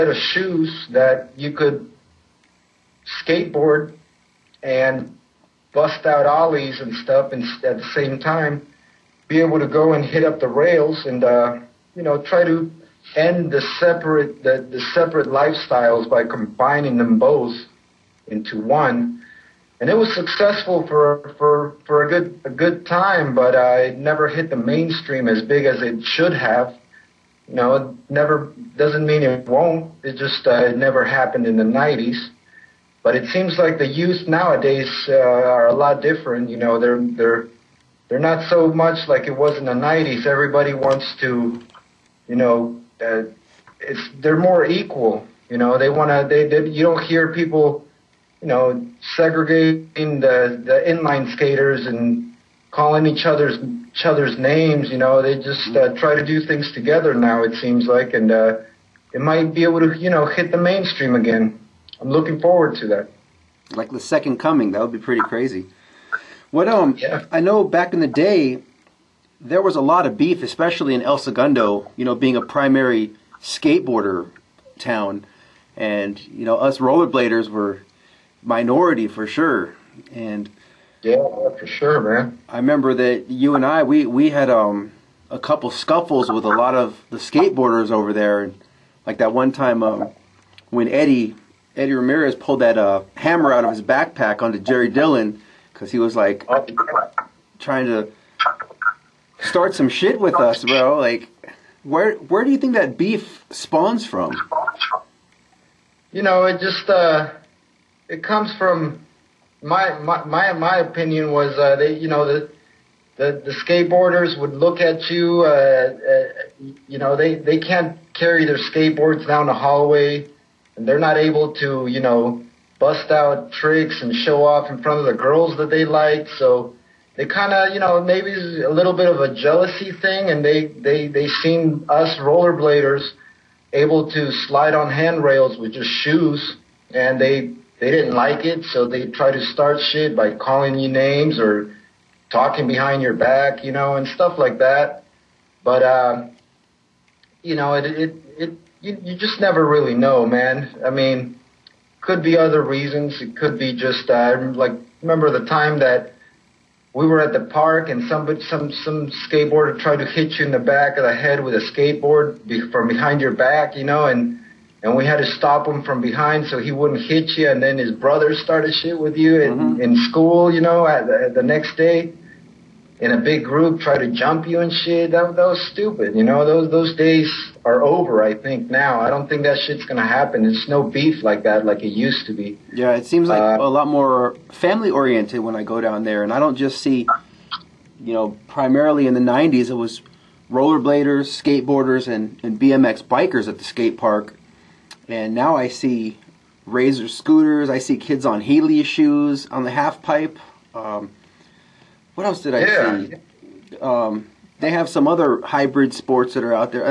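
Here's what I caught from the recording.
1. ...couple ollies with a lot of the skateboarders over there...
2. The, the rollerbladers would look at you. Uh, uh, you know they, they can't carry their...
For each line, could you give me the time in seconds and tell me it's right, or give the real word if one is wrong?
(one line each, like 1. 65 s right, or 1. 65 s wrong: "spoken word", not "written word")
1. 85 s wrong: "scuffles", not "ollies"
2. 113 s wrong: "skateboarders", not "rollerbladers".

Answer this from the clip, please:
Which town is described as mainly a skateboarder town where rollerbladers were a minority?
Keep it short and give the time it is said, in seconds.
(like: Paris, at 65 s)
El Segundo, at 71 s.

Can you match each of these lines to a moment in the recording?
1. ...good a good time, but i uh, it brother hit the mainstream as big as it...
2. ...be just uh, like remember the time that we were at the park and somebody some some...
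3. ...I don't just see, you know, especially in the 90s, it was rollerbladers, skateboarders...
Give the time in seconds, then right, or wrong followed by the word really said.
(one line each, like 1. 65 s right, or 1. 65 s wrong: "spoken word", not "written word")
1. 22 s wrong: "never", not "brother"
2. 153 s right
3. 186 s wrong: "primarily", not "especially".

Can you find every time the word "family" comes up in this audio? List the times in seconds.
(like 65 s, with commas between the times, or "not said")
184 s.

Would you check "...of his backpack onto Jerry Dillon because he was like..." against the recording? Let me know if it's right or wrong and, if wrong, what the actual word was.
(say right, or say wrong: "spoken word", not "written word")
right.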